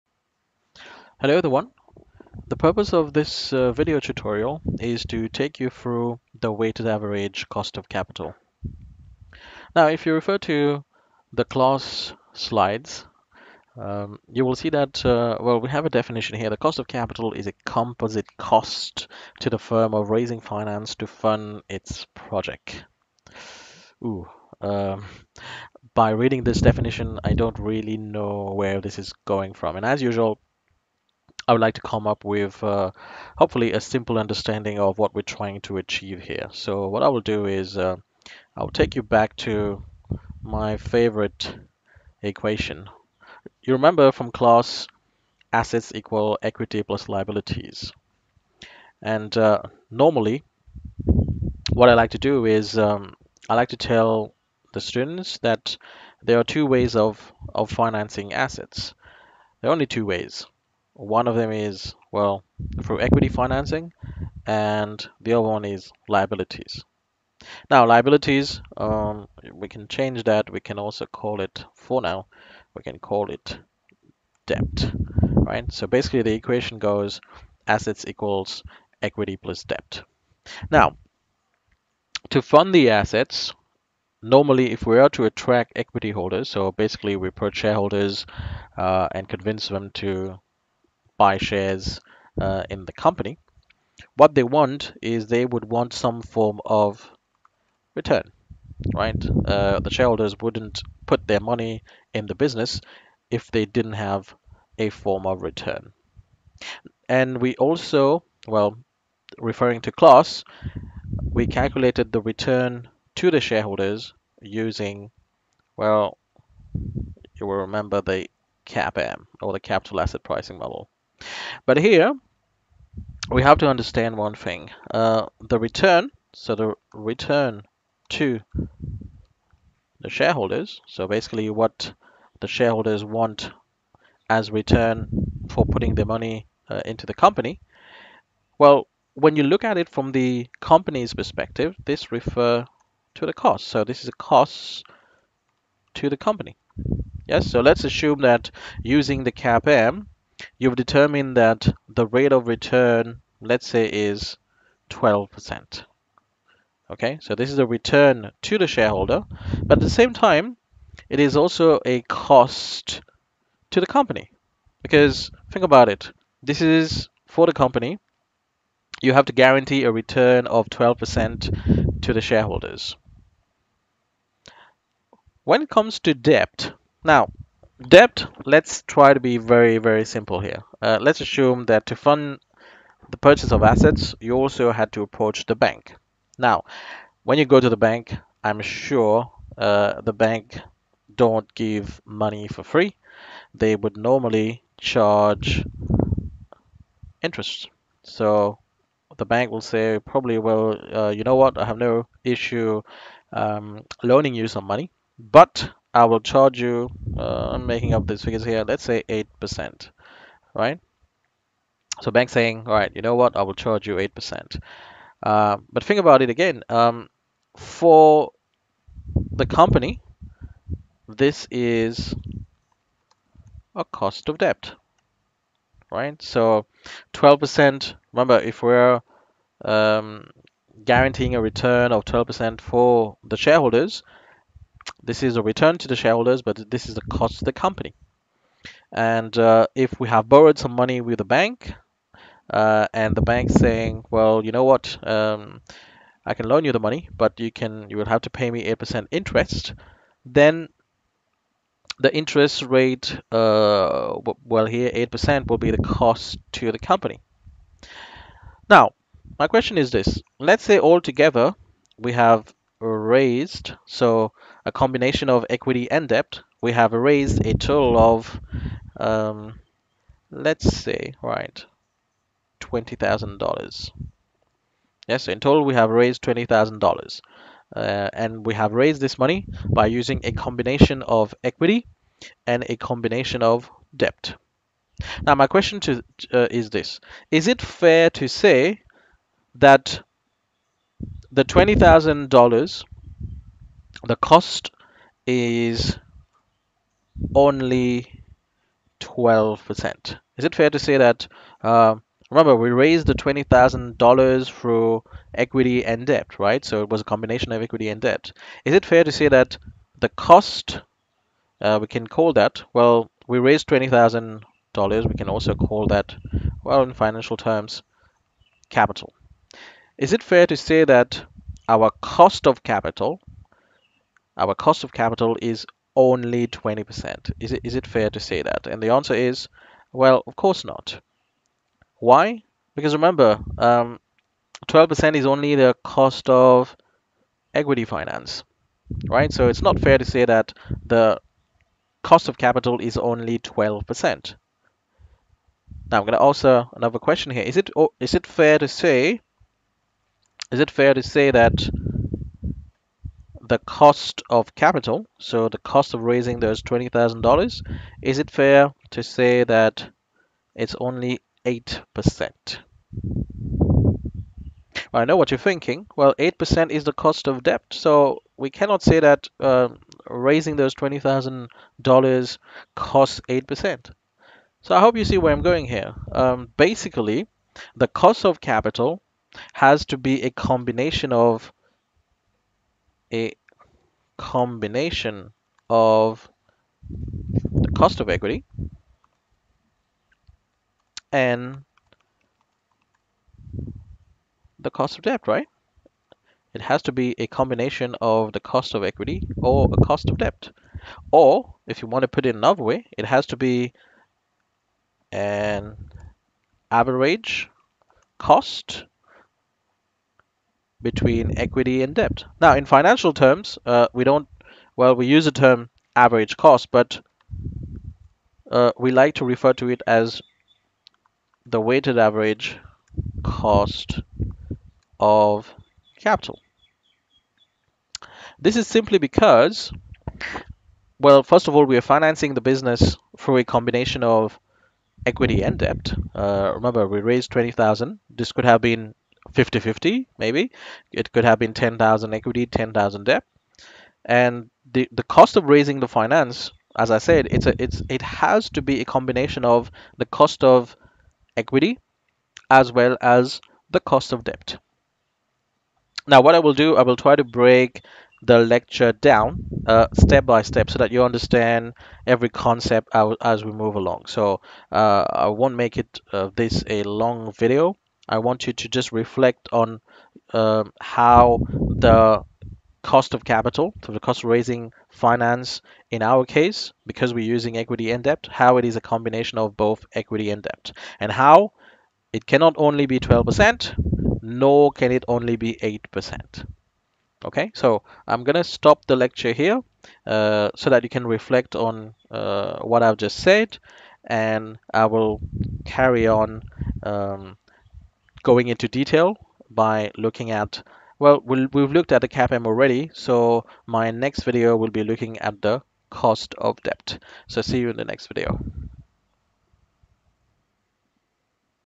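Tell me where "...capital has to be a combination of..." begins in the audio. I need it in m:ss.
6:18.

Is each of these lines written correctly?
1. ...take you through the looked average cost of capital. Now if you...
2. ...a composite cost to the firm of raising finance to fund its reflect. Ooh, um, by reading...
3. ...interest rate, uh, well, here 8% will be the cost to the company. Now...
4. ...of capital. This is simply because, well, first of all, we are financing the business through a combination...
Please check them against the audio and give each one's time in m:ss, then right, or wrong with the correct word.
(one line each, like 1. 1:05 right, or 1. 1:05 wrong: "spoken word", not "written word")
1. 0:05 wrong: "weighted", not "looked"
2. 0:17 wrong: "project", not "reflect"
3. 4:12 right
4. 7:04 right.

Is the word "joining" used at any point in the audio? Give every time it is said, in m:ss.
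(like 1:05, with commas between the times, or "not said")
not said.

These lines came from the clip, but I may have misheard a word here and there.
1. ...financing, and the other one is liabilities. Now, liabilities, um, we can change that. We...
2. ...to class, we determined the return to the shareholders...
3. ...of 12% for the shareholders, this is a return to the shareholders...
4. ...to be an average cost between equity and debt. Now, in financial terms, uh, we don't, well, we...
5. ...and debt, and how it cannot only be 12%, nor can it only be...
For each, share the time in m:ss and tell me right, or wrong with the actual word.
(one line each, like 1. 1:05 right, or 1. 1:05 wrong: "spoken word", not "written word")
1. 1:03 right
2. 1:49 wrong: "calculated", not "determined"
3. 3:51 right
4. 6:43 right
5. 8:00 right.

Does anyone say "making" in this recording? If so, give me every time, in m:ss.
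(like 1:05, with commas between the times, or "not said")
3:27.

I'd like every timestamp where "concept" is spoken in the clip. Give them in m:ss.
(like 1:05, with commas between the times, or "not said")
7:42.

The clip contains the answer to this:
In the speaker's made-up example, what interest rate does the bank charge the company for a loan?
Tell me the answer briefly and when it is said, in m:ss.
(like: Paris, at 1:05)
8%, at 3:28.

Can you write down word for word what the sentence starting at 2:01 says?
But here we have to understand one thing.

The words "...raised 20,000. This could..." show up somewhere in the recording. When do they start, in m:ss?
7:17.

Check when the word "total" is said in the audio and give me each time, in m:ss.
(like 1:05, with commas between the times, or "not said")
4:27, 4:35.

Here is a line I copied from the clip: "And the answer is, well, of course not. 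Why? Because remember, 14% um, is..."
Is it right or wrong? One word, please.
wrong.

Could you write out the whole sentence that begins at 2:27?
Yes, so let's assume that using the CAPM, you've determined that the rate of return, let's say, is 12%.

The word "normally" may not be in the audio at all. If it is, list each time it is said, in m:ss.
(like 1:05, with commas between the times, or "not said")
0:49, 1:24, 3:13.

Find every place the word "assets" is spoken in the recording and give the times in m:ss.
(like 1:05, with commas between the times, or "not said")
0:45, 0:58, 1:17, 1:22, 2:00, 3:03.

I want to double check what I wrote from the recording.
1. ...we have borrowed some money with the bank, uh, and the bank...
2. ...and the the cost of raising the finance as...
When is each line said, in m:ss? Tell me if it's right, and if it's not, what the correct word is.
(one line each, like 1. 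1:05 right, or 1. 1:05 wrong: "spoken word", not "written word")
1. 3:59 right
2. 7:24 right.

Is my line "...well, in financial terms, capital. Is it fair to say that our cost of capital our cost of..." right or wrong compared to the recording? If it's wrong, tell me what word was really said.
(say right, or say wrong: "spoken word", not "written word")
right.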